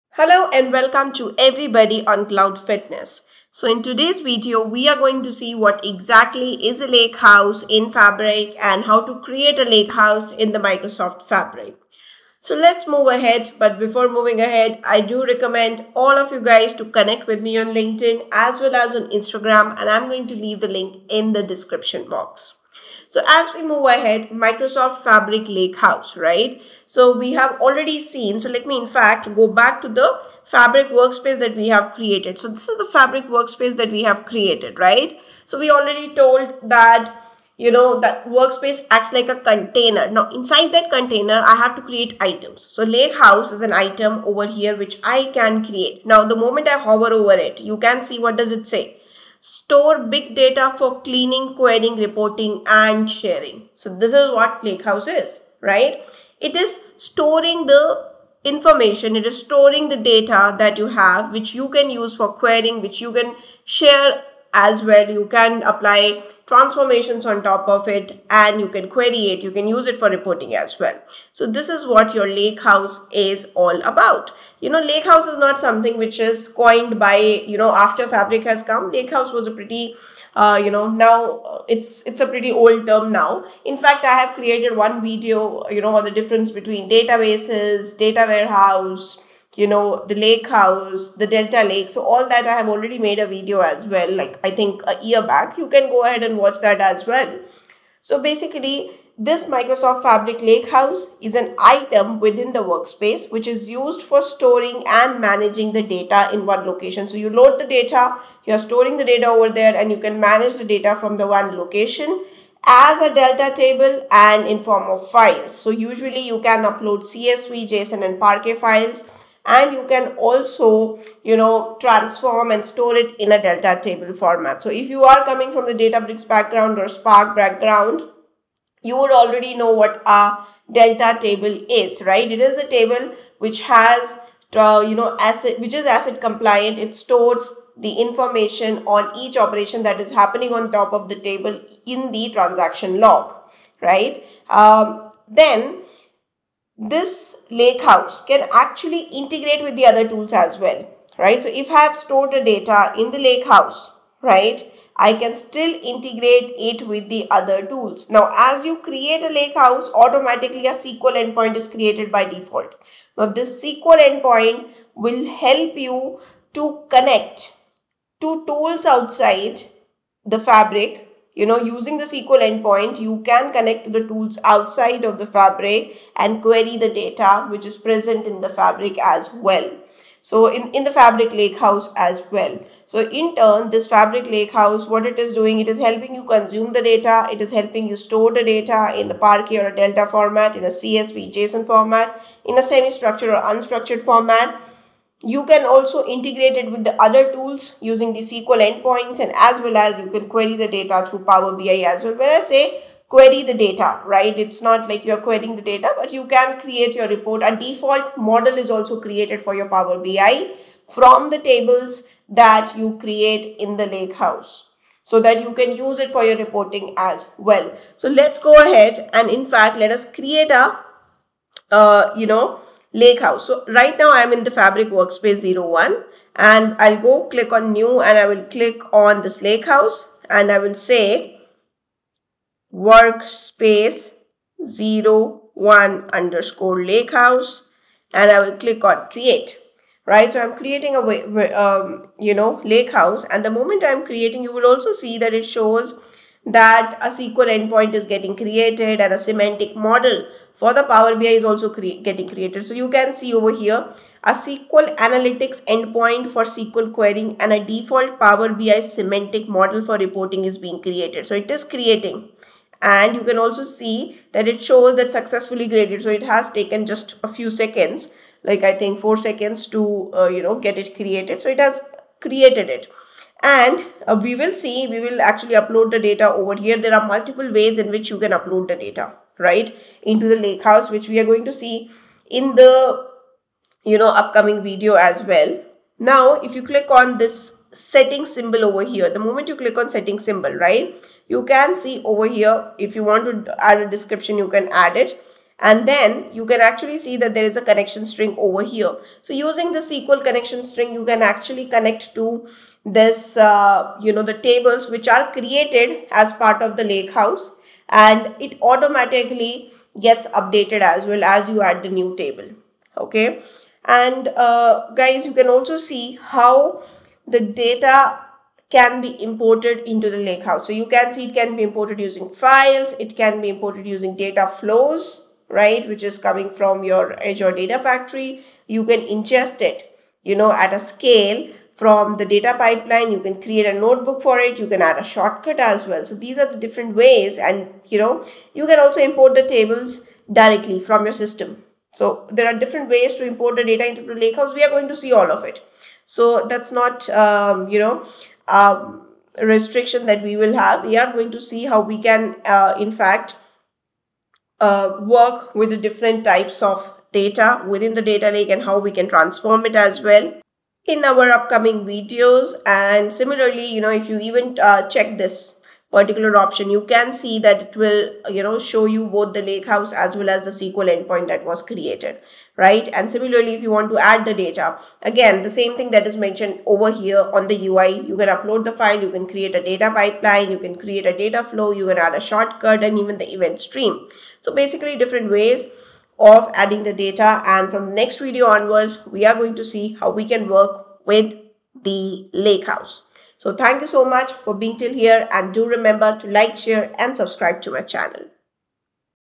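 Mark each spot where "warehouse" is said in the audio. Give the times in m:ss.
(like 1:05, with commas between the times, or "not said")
1:28.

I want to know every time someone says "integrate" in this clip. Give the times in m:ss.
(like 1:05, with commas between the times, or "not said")
2:29, 2:35, 3:16.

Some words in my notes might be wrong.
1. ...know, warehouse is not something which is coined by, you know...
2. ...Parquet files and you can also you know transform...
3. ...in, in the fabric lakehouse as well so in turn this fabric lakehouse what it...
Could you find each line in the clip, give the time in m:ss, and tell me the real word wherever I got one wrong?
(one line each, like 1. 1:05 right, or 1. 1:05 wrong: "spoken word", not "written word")
1. 1:14 wrong: "lakehouse", not "warehouse"
2. 1:58 right
3. 3:00 right.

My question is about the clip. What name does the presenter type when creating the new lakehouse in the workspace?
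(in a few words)
workspace 01_lakehouse.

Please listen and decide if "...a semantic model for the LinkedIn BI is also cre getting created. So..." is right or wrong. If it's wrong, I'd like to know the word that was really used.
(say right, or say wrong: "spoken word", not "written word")
wrong: "Power", not "LinkedIn".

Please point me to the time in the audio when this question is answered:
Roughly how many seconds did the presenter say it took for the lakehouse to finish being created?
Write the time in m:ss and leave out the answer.
4:28.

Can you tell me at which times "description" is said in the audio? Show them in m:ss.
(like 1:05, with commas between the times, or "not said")
0:21, 4:53.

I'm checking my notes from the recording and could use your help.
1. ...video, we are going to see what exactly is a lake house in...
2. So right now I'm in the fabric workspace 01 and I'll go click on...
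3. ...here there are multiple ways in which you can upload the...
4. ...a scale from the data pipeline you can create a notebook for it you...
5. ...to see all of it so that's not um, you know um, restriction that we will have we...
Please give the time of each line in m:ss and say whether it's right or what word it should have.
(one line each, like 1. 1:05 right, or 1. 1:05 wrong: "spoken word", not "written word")
1. 0:04 right
2. 3:43 right
3. 4:36 right
4. 5:30 right
5. 5:44 right.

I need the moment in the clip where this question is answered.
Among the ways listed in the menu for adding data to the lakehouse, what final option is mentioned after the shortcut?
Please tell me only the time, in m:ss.
6:23.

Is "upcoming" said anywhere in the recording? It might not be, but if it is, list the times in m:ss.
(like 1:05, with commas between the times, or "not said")
4:44, 6:01.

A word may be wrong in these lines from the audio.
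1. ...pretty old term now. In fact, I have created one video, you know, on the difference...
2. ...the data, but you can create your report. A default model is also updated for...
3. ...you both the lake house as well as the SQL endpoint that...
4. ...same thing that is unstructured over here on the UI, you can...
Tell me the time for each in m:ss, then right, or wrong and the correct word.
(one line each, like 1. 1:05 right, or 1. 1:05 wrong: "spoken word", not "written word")
1. 1:22 right
2. 3:25 wrong: "created", not "updated"
3. 6:08 right
4. 6:15 wrong: "mentioned", not "unstructured".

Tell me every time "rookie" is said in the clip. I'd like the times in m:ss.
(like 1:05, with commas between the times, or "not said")
not said.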